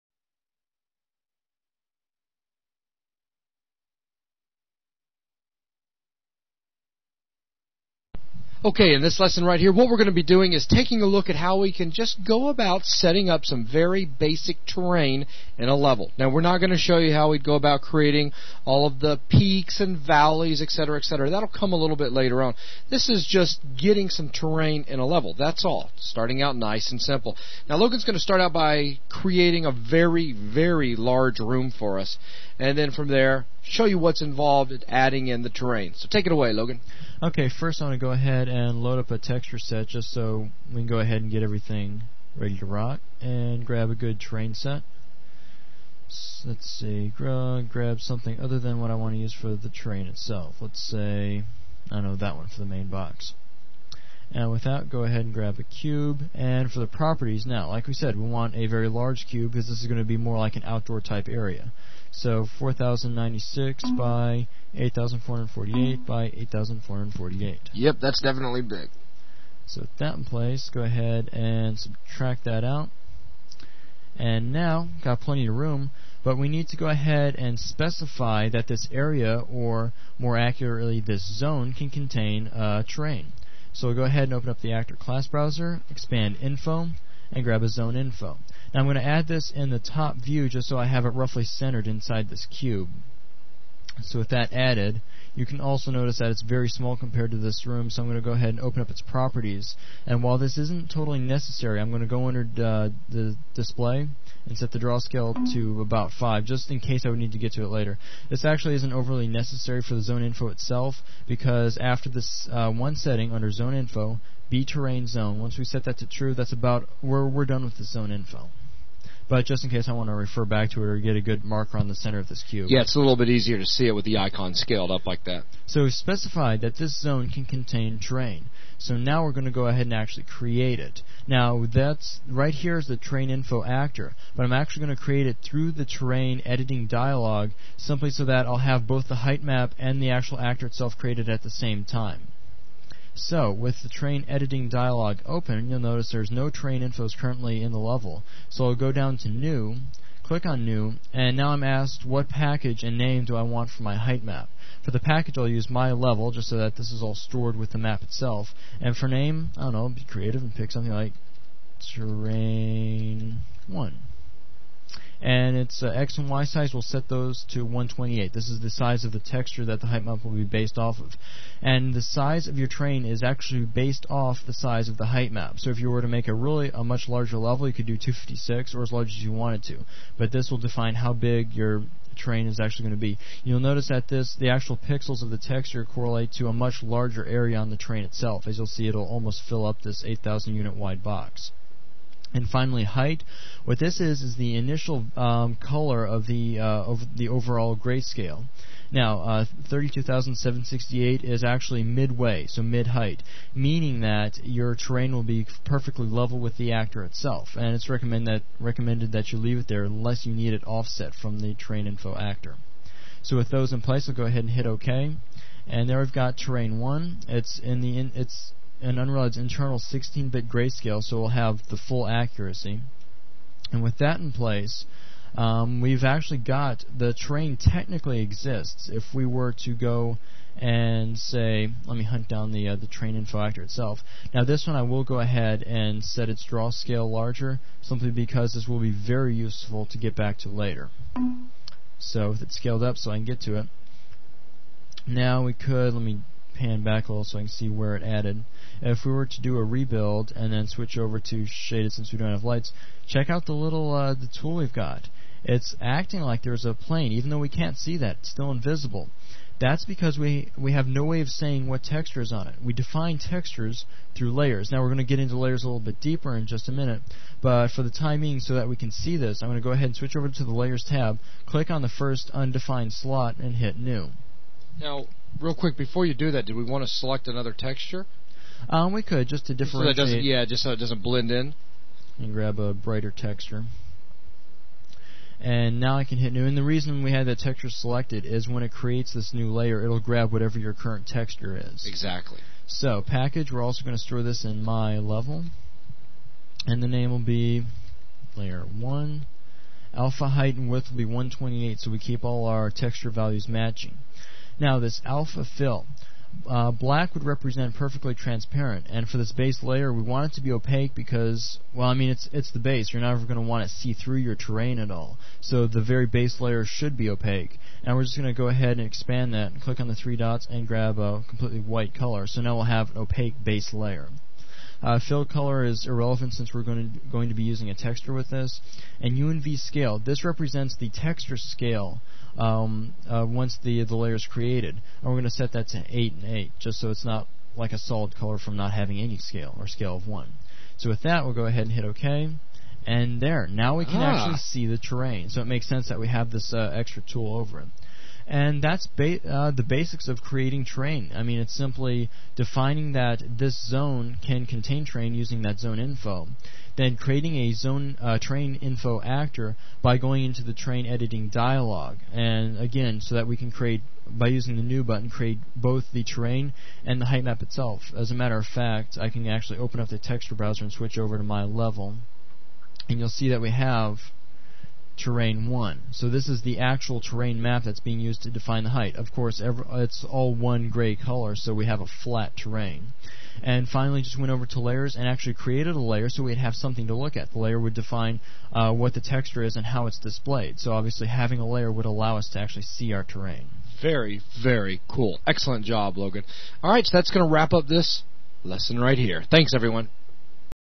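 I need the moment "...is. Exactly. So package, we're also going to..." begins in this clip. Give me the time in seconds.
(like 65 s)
291 s.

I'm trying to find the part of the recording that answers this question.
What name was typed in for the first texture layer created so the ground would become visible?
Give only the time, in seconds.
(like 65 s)
298 s.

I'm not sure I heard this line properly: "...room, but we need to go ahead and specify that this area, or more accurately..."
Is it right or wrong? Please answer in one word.
right.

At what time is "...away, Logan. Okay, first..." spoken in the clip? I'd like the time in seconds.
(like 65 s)
36 s.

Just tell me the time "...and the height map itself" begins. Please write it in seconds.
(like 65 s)
366 s.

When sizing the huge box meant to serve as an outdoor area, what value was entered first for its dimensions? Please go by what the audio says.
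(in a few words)
4096.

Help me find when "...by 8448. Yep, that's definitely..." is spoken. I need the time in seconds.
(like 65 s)
66 s.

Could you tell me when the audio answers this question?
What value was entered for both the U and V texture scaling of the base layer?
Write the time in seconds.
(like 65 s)
335 s.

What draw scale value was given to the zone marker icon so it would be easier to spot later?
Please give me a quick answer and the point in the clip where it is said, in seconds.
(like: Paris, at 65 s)
5, at 106 s.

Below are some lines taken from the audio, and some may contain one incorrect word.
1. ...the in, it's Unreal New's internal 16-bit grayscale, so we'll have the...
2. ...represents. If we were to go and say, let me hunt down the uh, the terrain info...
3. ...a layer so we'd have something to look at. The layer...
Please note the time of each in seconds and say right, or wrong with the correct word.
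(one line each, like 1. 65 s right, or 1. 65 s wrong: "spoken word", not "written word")
1. 217 s wrong: "Unreal", not "New"
2. 228 s wrong: "exists", not "represents"
3. 385 s right.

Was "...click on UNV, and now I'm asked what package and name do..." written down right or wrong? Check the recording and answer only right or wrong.
wrong.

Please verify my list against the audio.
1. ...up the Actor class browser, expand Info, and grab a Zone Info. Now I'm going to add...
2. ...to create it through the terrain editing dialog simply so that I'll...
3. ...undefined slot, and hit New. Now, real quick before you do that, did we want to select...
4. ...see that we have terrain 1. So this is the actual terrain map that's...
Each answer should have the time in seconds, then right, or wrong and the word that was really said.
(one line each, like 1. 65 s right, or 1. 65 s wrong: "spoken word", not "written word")
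1. 84 s right
2. 134 s right
3. 272 s right
4. 373 s right.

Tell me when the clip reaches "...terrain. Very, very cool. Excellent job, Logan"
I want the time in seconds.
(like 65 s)
393 s.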